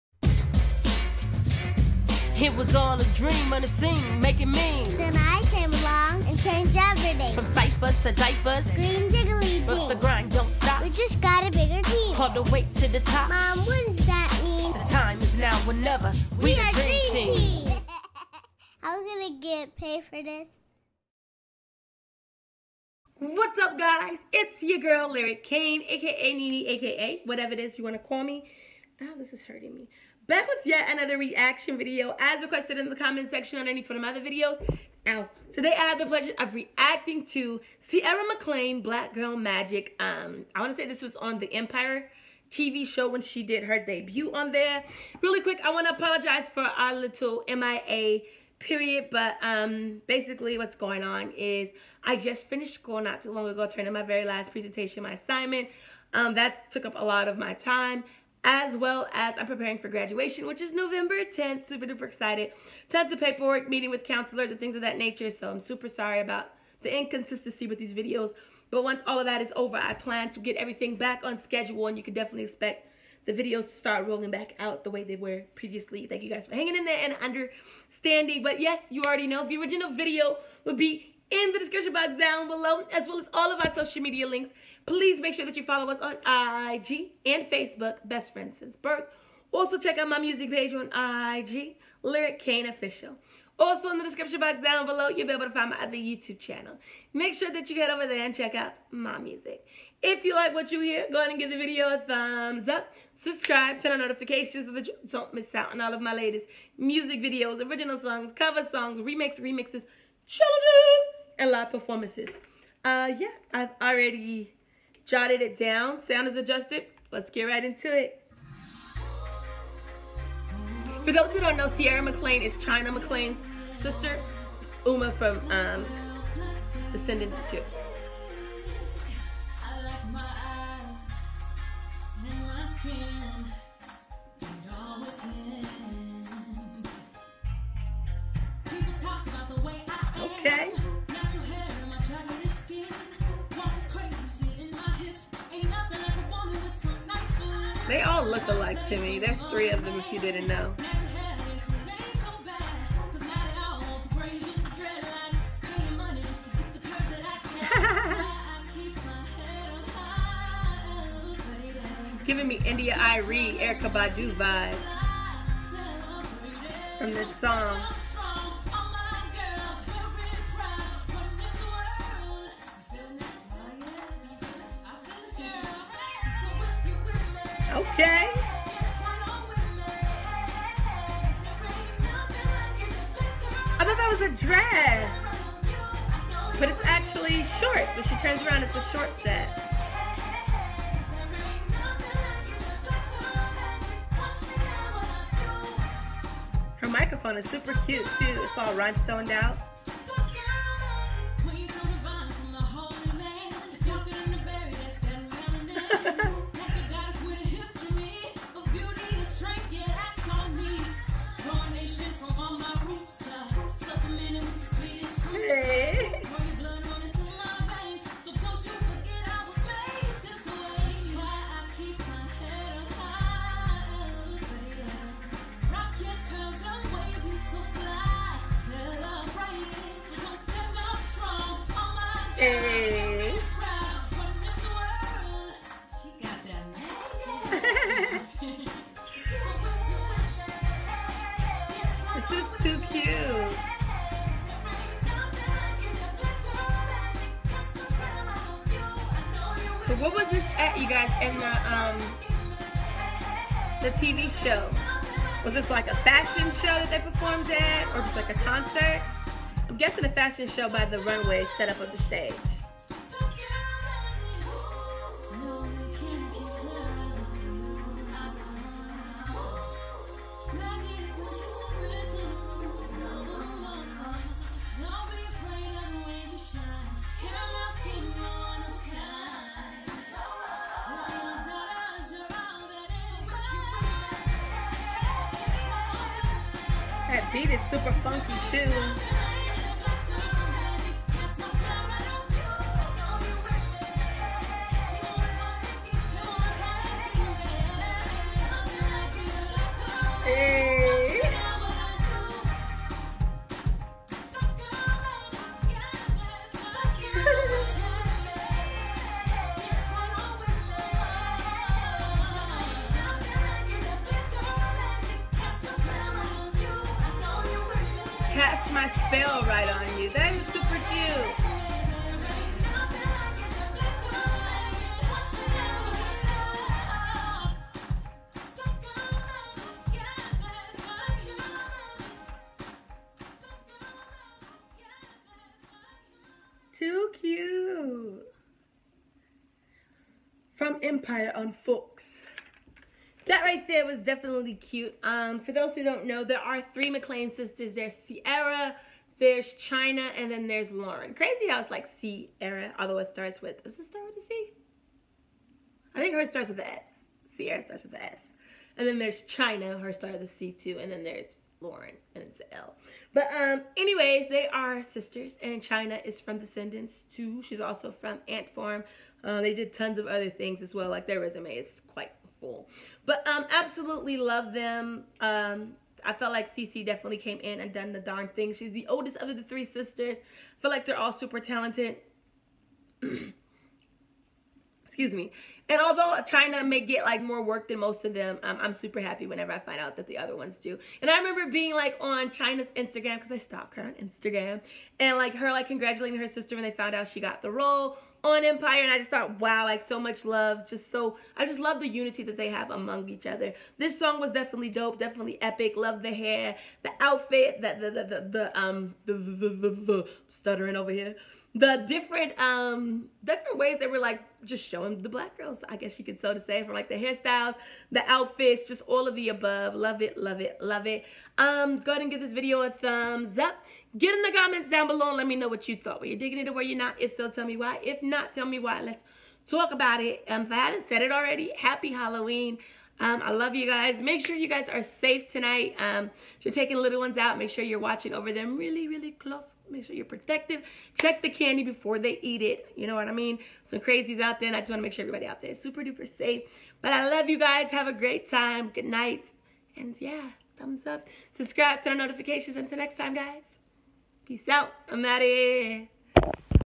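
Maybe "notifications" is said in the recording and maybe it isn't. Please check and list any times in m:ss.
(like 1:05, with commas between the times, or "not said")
1:43, 7:32.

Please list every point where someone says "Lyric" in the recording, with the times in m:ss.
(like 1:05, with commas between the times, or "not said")
0:25, 1:32.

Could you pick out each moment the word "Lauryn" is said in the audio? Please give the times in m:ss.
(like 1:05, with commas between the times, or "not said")
5:50, 6:01.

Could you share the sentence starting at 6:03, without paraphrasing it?
But um, anyways, they are sisters, and China is from Descendants too.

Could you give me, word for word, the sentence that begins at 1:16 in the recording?
Thank you guys for hanging in there and understanding.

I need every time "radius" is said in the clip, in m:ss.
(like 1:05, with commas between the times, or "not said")
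not said.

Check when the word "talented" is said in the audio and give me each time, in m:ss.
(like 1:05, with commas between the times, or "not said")
6:21.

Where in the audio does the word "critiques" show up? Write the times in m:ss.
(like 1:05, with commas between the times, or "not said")
not said.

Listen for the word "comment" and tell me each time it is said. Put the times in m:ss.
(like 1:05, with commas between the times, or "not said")
0:32, 7:04.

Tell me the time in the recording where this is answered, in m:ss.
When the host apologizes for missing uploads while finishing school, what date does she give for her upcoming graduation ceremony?
1:00.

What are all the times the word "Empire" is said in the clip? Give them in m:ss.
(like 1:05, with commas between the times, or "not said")
0:41, 5:40, 6:38.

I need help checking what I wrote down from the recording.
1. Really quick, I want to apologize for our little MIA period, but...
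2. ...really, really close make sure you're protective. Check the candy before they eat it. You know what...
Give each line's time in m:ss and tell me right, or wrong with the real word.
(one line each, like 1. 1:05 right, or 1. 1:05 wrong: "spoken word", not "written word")
1. 0:45 right
2. 7:18 right.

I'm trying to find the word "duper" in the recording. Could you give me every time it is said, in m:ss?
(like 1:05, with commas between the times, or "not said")
1:01, 7:25.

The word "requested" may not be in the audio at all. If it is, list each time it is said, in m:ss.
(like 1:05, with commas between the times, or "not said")
0:32.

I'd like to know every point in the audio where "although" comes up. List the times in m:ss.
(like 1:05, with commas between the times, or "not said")
5:52, 6:25.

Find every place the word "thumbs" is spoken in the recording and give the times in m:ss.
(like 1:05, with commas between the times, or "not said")
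1:41, 7:02, 7:30.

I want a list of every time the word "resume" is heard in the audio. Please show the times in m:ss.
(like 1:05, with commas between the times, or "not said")
6:11.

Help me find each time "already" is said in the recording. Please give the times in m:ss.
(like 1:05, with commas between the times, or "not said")
1:19, 1:53, 7:11.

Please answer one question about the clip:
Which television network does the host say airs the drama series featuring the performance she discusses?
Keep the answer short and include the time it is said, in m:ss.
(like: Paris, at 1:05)
Fox, at 5:41.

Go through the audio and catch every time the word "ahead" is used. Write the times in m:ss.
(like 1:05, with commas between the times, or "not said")
1:41, 7:01.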